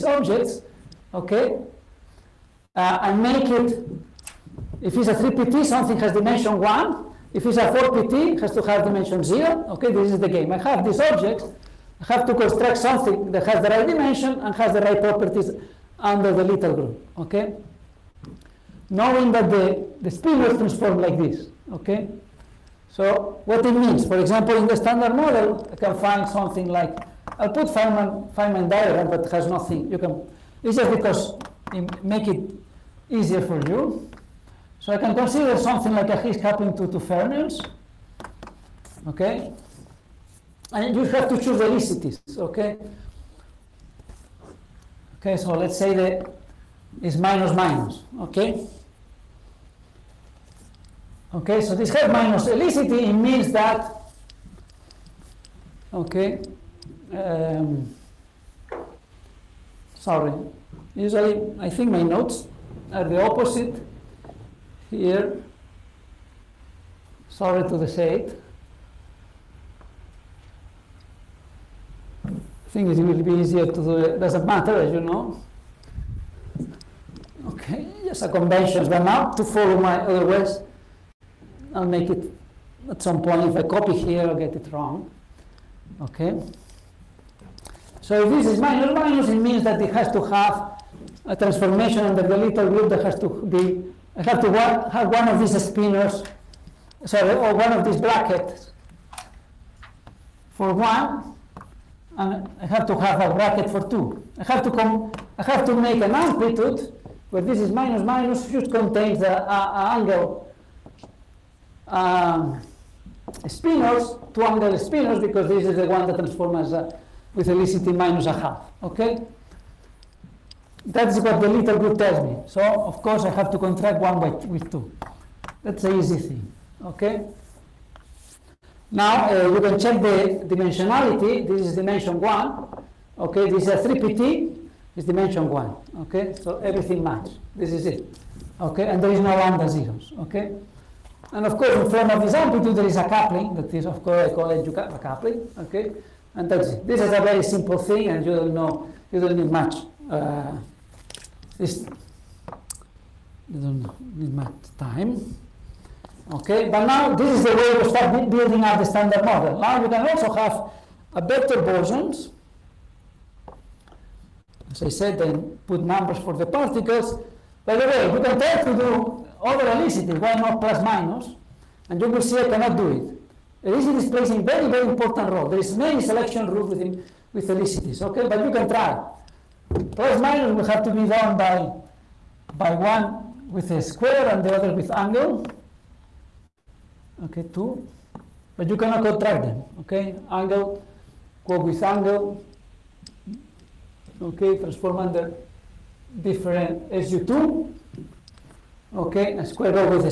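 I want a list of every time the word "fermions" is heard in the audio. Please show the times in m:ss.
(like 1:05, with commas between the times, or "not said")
0:36.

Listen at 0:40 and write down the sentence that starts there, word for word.
And you have to choose elicities, okay?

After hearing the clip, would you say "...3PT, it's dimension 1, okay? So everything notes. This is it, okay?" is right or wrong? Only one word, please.
wrong.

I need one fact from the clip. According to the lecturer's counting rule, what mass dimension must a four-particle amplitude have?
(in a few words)
0.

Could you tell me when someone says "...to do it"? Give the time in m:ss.
1:13.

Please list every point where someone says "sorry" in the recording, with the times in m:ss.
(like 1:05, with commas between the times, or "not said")
0:59, 1:07, 1:37.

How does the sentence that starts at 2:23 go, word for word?
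That is, of course, I call it a coupling, okay?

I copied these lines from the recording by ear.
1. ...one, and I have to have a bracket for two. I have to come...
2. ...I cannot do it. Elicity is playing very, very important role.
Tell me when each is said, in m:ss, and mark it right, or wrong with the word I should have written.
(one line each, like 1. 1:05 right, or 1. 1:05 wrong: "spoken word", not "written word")
1. 1:40 right
2. 2:52 right.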